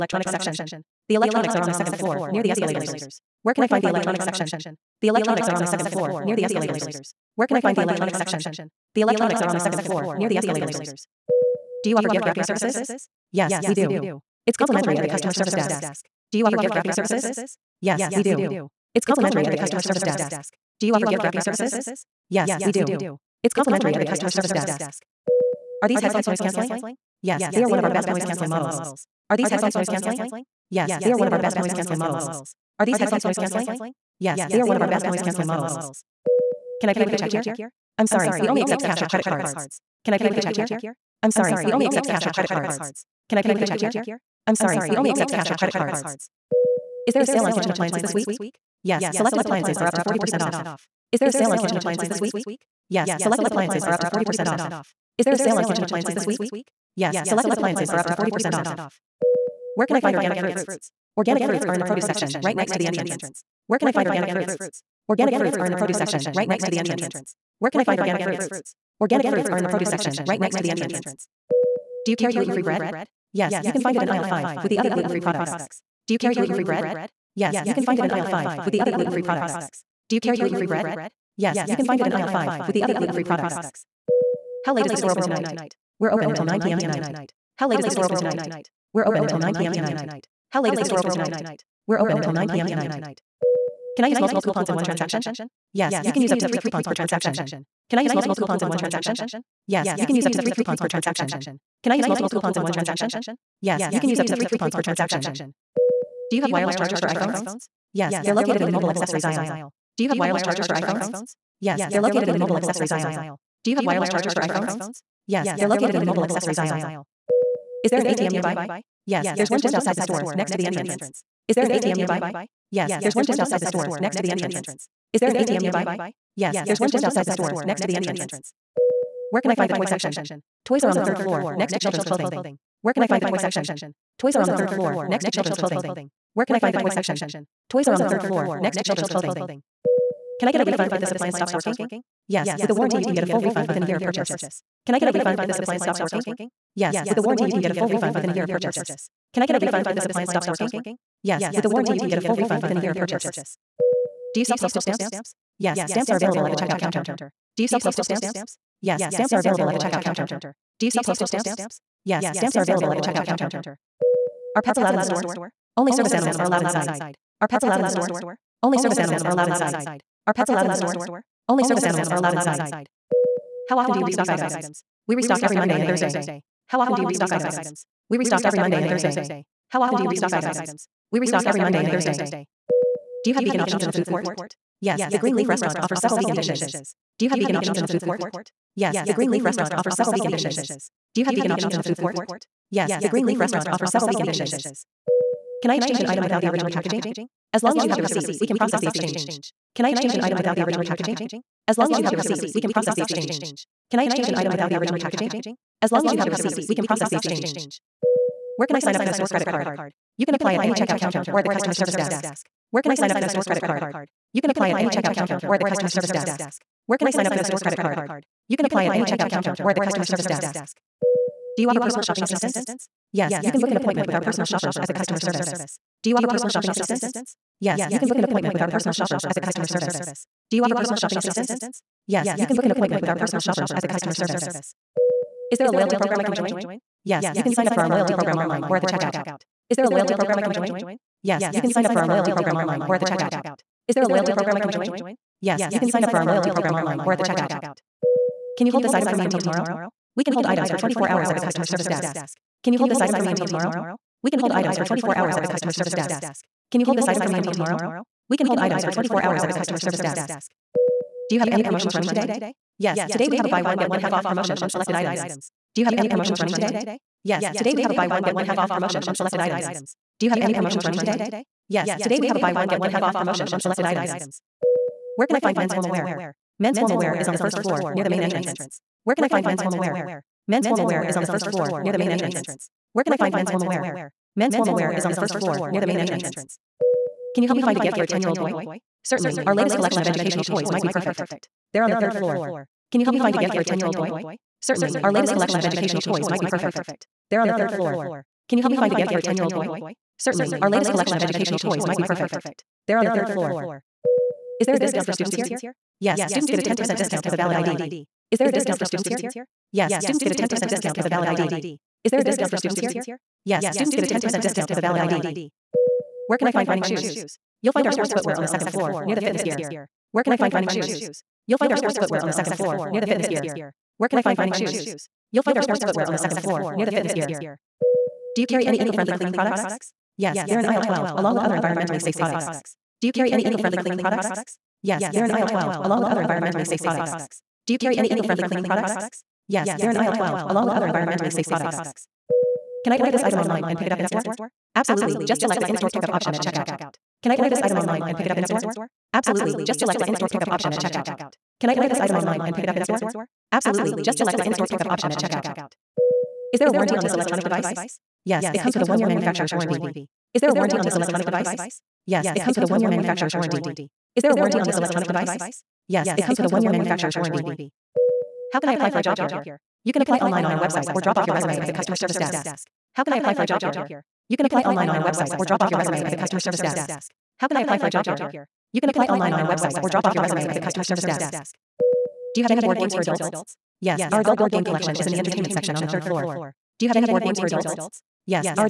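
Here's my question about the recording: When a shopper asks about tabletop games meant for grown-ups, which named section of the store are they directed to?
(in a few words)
Entertainment section.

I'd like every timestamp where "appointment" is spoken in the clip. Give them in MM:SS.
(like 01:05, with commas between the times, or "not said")
03:43, 03:48, 03:52.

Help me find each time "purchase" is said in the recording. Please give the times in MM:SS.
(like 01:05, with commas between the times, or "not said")
02:24, 02:28, 02:32.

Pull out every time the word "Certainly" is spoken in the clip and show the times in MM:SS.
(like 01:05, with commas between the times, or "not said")
04:49, 04:54, 05:00.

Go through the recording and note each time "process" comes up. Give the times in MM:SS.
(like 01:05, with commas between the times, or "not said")
03:18, 03:22, 03:26.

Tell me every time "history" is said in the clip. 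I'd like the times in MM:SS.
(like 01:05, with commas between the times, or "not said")
not said.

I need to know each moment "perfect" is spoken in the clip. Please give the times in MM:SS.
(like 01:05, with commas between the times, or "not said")
04:50, 04:56, 05:02.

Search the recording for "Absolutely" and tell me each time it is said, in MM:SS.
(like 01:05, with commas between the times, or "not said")
05:44, 05:49, 05:53.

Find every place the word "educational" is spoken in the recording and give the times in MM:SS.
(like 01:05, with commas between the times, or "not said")
04:50, 04:55, 05:01.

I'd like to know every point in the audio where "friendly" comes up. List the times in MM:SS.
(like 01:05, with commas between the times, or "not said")
05:28, 05:33, 05:38.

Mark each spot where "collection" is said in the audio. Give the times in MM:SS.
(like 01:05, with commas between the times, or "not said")
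04:49, 04:55, 05:00, 06:24.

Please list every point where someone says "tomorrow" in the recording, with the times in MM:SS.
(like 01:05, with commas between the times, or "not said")
04:09, 04:13, 04:17.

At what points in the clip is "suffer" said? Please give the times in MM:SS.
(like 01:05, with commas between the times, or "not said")
not said.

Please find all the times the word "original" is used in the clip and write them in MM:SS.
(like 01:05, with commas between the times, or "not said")
03:16, 03:20, 03:24.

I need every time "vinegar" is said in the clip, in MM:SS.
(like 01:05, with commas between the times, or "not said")
not said.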